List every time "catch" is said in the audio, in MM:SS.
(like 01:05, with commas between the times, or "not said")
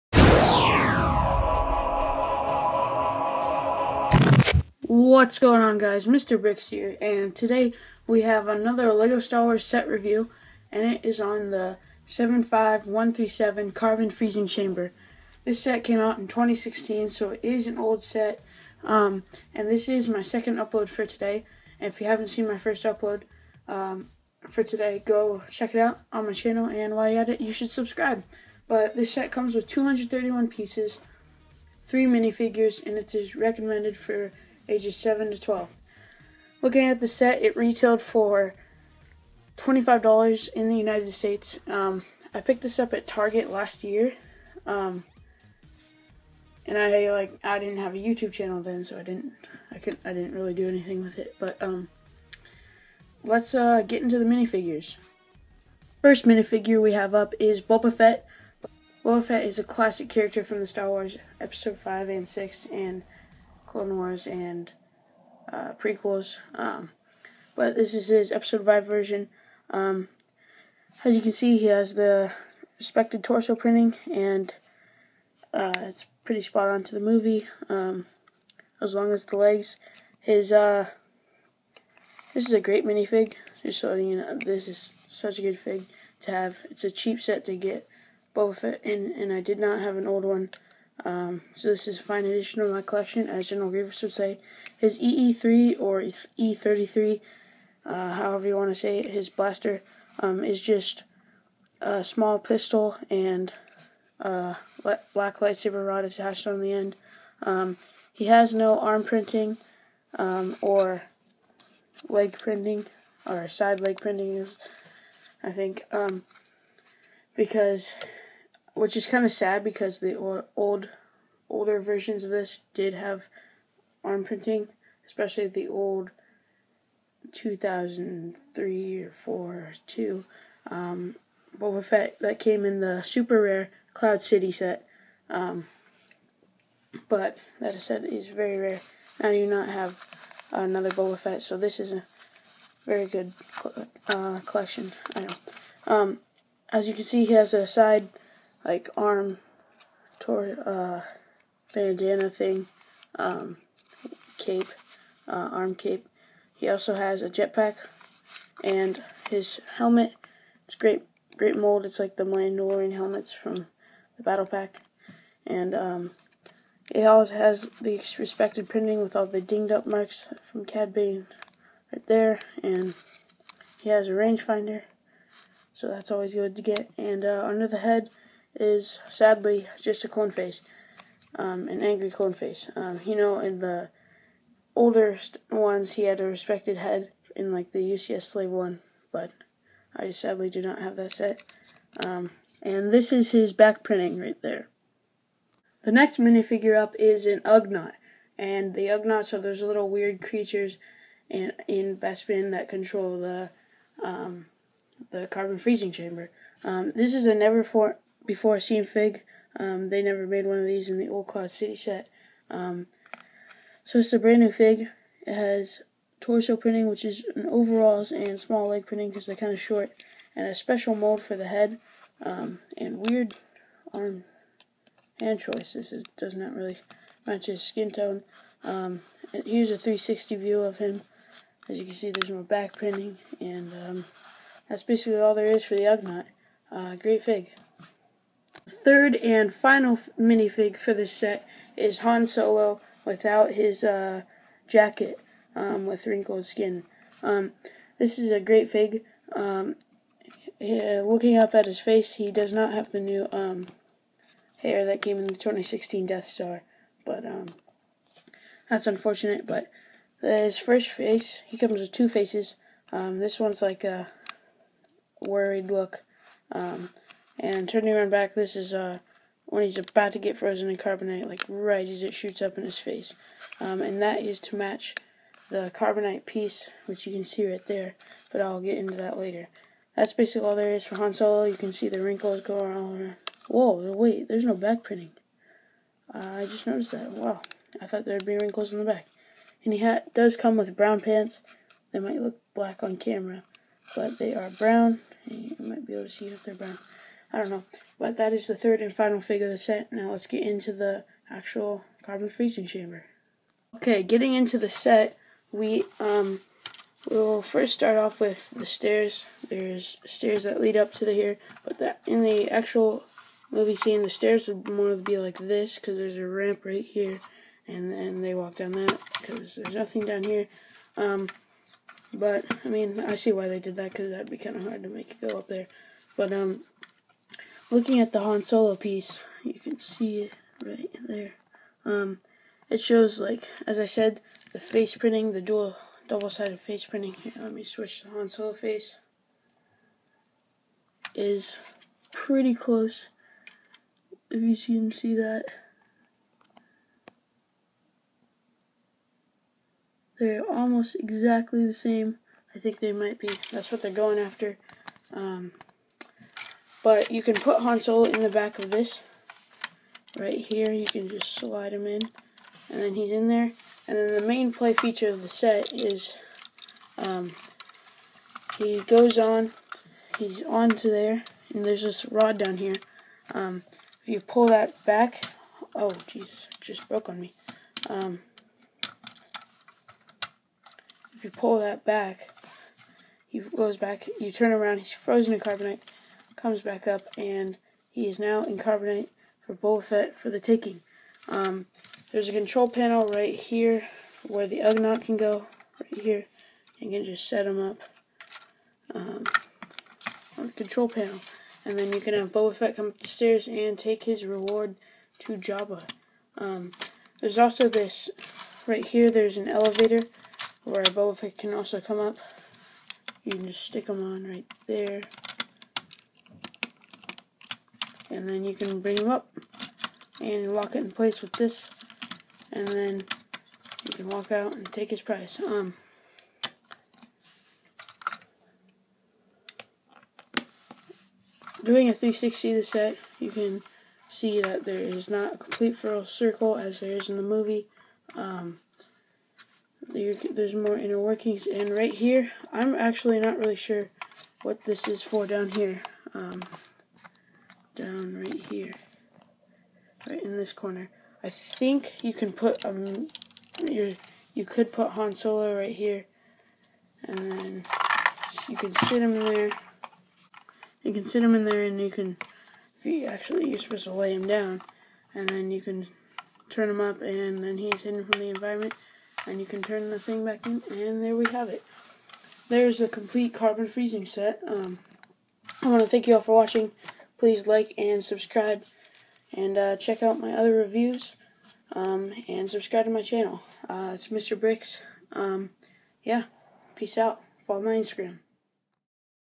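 not said.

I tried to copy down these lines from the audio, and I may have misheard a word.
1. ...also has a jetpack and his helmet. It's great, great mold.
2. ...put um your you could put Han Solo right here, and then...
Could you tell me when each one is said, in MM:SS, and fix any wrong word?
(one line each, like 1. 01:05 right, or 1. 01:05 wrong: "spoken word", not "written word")
1. 02:36 right
2. 07:32 right.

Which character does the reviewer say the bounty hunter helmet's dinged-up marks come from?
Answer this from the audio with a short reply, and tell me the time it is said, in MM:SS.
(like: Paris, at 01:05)
Cad Bane, at 02:50.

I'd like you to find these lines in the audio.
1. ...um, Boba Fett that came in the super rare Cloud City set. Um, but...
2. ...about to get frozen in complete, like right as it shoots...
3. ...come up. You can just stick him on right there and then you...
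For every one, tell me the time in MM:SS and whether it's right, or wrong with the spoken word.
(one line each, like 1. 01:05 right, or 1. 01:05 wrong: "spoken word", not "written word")
1. 02:10 right
2. 04:29 wrong: "carbonite", not "complete"
3. 06:51 right.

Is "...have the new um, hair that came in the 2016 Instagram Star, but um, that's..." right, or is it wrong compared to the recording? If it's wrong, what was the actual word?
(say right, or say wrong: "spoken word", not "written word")
wrong: "Death", not "Instagram".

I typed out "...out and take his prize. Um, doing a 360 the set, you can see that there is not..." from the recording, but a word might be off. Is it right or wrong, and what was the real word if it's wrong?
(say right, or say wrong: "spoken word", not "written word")
right.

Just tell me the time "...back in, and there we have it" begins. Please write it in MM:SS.
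07:50.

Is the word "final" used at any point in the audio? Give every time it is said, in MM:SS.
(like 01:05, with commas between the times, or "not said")
03:59, 04:58.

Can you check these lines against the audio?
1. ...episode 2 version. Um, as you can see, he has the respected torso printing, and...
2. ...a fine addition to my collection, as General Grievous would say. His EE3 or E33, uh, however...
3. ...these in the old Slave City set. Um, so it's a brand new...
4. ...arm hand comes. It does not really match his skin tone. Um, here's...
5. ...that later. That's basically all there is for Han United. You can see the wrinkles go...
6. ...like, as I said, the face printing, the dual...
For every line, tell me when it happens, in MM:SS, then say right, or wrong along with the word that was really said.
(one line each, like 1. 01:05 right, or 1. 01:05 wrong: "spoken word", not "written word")
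1. 01:08 wrong: "5", not "2"
2. 01:31 right
3. 03:30 wrong: "Cloud", not "Slave"
4. 03:43 wrong: "choices", not "comes"
5. 04:38 wrong: "Solo", not "United"
6. 05:33 right.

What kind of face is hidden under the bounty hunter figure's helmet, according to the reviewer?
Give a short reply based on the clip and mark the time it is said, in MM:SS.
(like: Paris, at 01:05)
An angry clone face, at 03:01.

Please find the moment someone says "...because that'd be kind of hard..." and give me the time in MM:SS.
05:23.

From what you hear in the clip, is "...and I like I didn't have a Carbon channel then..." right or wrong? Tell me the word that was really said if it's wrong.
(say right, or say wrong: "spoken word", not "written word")
wrong: "YouTube", not "Carbon".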